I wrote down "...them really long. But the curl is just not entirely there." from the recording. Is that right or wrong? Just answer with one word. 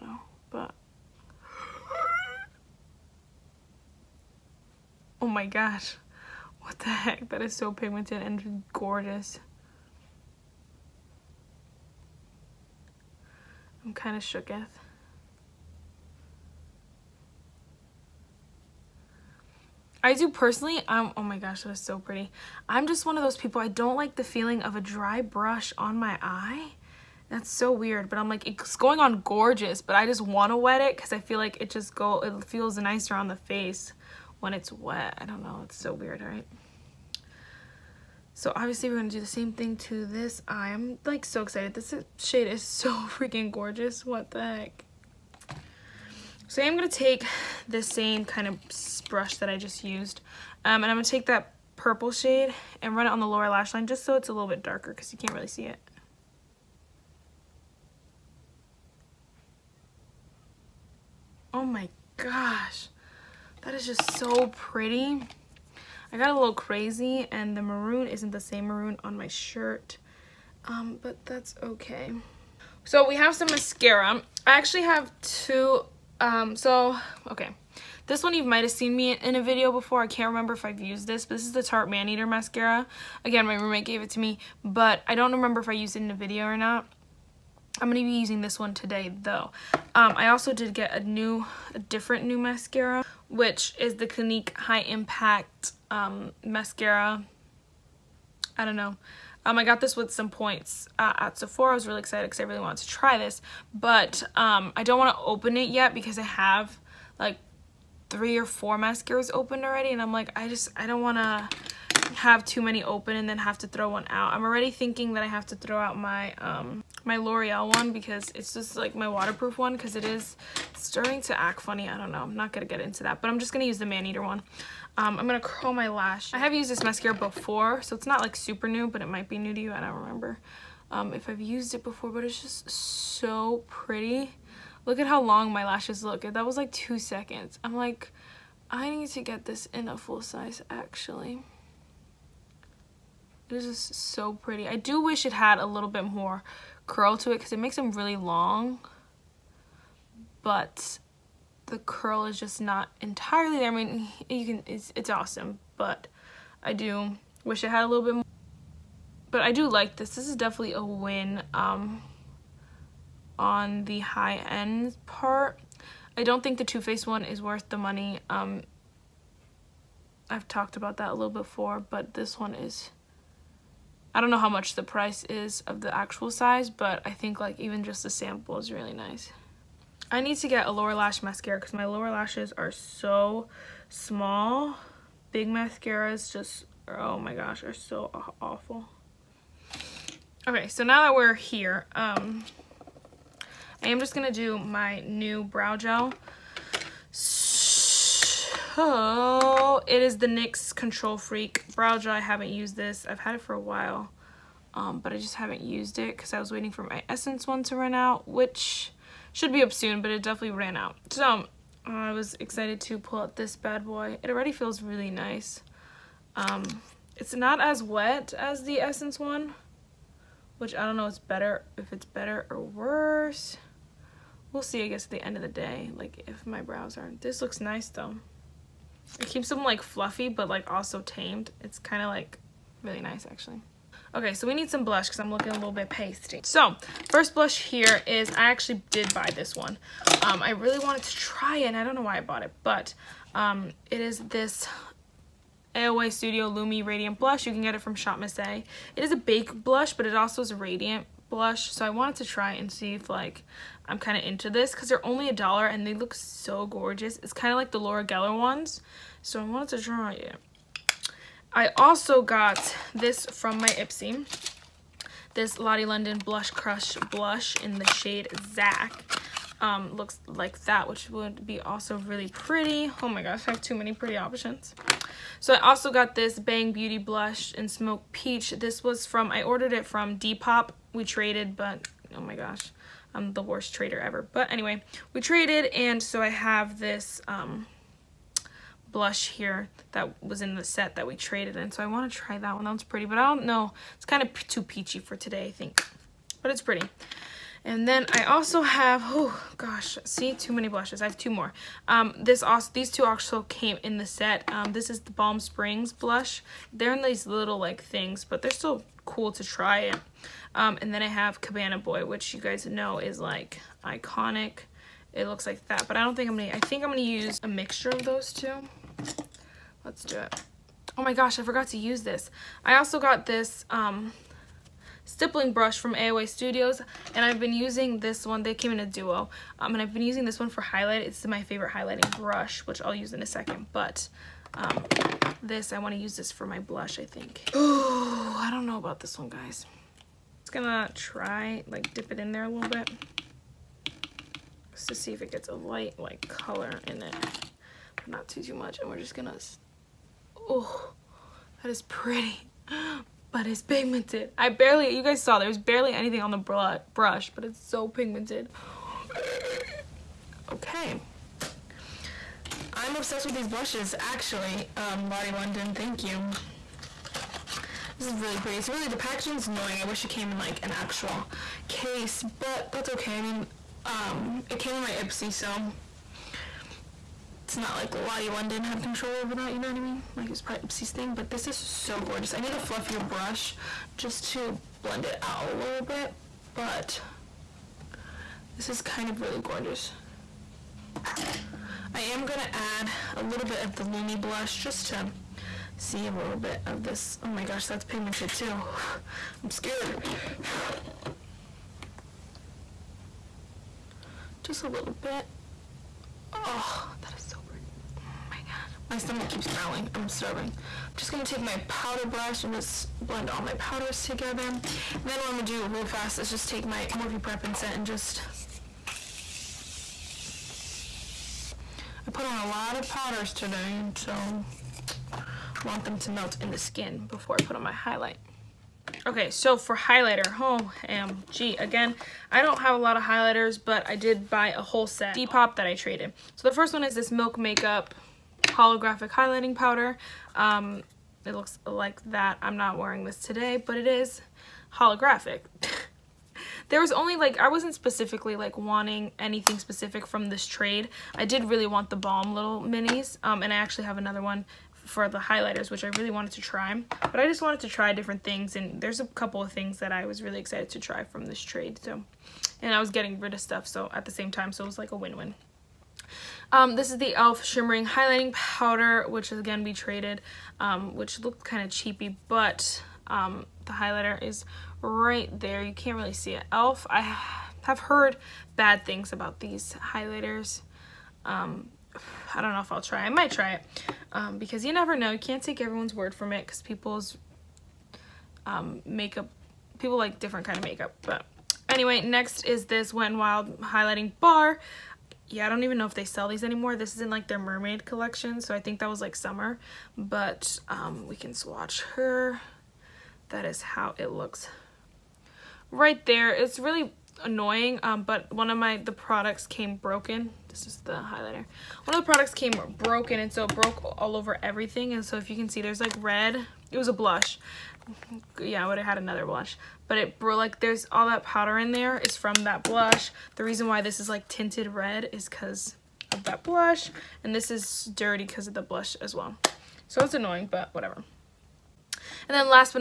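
right.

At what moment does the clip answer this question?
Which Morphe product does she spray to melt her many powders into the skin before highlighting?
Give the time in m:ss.
6:57.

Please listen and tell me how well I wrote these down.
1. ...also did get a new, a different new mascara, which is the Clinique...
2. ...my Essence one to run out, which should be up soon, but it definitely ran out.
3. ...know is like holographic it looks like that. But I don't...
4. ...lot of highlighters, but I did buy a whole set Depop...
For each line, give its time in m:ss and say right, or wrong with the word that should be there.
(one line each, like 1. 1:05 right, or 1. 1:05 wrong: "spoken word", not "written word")
1. 1:30 right
2. 3:26 right
3. 5:12 wrong: "iconic", not "holographic"
4. 7:12 right.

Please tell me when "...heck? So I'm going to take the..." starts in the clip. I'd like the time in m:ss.
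0:44.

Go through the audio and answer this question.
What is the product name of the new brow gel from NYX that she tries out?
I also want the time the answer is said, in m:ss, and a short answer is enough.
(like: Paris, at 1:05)
Control Freak, at 3:20.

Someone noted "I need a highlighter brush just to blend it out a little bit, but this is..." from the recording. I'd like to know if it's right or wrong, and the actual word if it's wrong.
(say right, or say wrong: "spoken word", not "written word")
wrong: "fluffier", not "highlighter".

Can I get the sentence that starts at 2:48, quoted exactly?
Um, I've talked about that a little before, but this one is...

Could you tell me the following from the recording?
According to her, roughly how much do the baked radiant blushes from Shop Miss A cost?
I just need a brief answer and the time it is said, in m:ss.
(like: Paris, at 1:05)
a dollar, at 4:15.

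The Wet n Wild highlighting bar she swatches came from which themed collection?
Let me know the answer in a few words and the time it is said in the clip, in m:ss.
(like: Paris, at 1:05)
mermaid collection, at 8:17.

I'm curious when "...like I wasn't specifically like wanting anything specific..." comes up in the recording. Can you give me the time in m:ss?
7:27.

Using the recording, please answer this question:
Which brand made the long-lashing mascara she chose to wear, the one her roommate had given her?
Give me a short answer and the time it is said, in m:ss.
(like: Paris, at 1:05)
Tarte, at 1:21.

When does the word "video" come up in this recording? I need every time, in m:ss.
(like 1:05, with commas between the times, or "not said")
1:19, 1:26.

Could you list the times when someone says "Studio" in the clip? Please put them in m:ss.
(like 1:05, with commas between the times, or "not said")
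4:06, 5:26.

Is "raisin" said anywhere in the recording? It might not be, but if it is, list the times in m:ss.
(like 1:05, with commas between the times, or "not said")
not said.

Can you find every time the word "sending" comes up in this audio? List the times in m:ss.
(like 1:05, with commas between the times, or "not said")
not said.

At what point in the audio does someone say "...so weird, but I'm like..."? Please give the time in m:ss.
0:27.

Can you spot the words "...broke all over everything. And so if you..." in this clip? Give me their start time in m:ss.
8:33.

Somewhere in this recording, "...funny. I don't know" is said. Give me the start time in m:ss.
2:01.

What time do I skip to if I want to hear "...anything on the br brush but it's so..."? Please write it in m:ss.
5:55.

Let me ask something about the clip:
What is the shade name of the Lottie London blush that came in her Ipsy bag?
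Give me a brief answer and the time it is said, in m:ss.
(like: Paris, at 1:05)
Zach, at 4:28.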